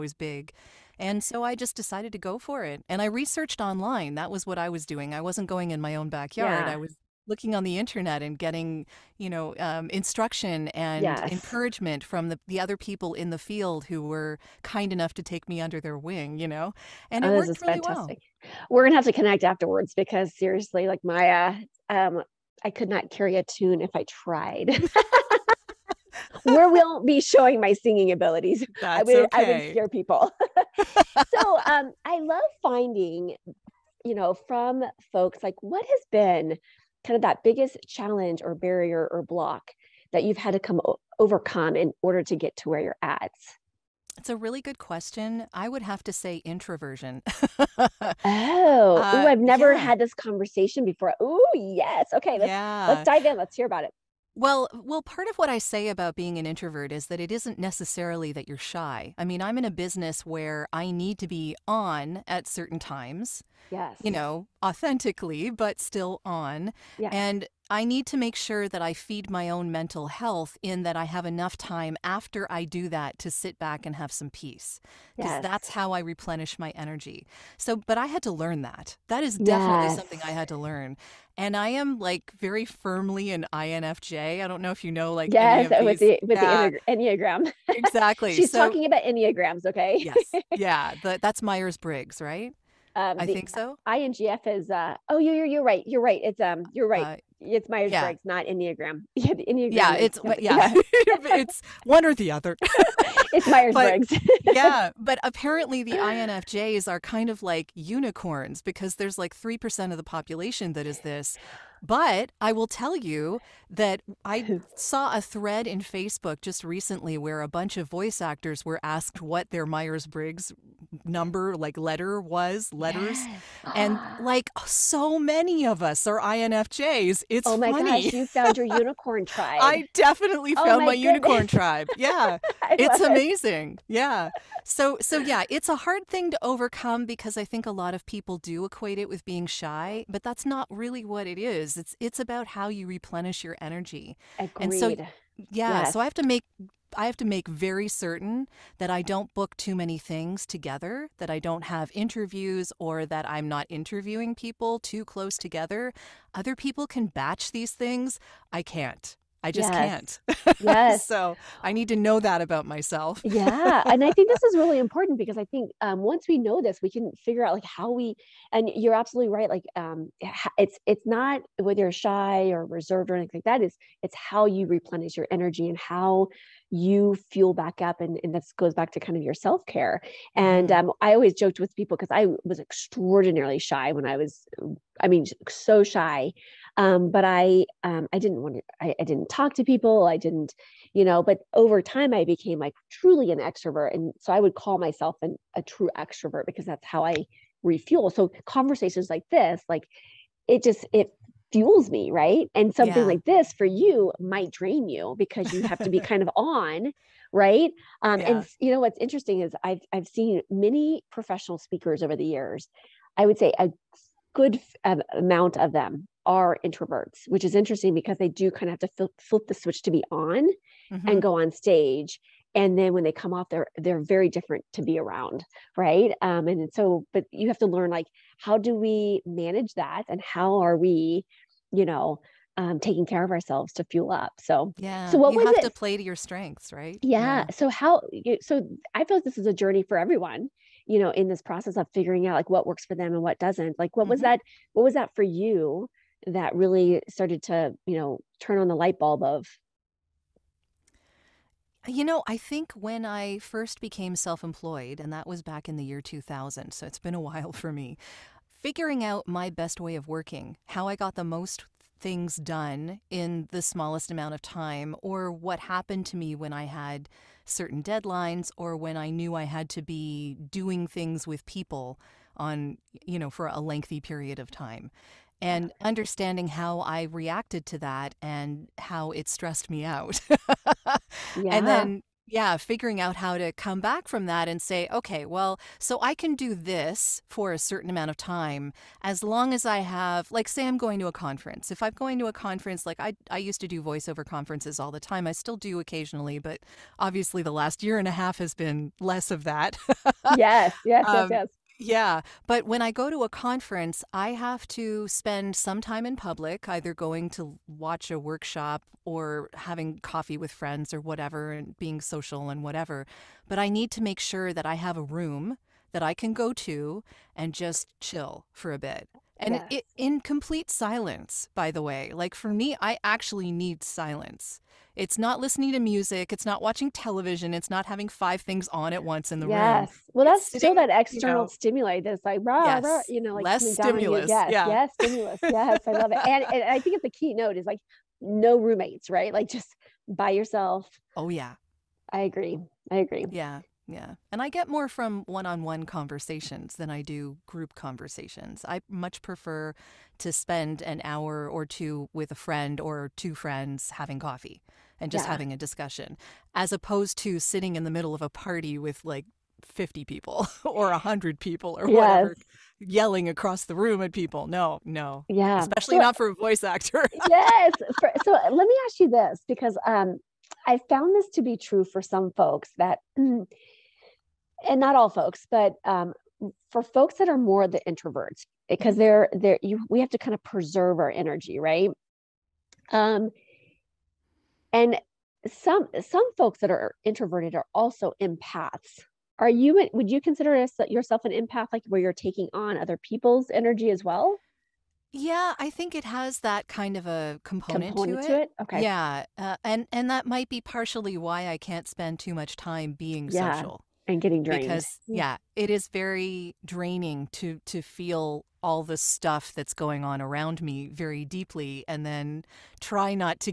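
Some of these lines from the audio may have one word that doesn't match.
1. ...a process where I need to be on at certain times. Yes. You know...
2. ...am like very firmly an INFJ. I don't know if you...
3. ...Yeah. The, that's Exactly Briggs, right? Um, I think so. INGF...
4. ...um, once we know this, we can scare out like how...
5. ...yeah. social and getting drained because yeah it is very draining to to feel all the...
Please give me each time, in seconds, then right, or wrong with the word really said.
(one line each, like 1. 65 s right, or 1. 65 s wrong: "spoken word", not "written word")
1. 59 s wrong: "business", not "process"
2. 81 s right
3. 90 s wrong: "Myers", not "Exactly"
4. 165 s wrong: "figure", not "scare"
5. 403 s right.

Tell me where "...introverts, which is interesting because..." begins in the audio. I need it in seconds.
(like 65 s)
216 s.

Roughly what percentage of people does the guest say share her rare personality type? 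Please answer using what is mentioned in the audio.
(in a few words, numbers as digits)
3 percent.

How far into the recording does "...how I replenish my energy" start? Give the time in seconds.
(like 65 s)
75 s.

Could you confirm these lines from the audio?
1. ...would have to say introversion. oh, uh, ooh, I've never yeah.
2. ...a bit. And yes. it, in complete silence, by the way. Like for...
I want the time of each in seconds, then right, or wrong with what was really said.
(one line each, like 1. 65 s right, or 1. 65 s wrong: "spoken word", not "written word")
1. 45 s right
2. 318 s right.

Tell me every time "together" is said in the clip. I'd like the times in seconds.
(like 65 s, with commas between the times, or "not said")
150 s, 155 s.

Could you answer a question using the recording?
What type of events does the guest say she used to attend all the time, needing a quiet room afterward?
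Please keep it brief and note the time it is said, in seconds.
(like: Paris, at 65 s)
Voiceover conferences, at 293 s.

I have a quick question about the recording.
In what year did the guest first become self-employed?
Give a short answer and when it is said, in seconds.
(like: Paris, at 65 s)
2000, at 255 s.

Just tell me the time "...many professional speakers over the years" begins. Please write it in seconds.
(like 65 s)
210 s.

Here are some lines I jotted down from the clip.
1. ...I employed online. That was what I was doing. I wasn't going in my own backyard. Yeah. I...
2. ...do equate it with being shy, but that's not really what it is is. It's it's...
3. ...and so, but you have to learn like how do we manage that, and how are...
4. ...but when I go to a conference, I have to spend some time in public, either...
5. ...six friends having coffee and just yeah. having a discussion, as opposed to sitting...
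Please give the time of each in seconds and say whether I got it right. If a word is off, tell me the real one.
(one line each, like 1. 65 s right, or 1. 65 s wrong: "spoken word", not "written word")
1. 3 s wrong: "researched", not "employed"
2. 138 s right
3. 226 s right
4. 302 s right
5. 353 s wrong: "two", not "six".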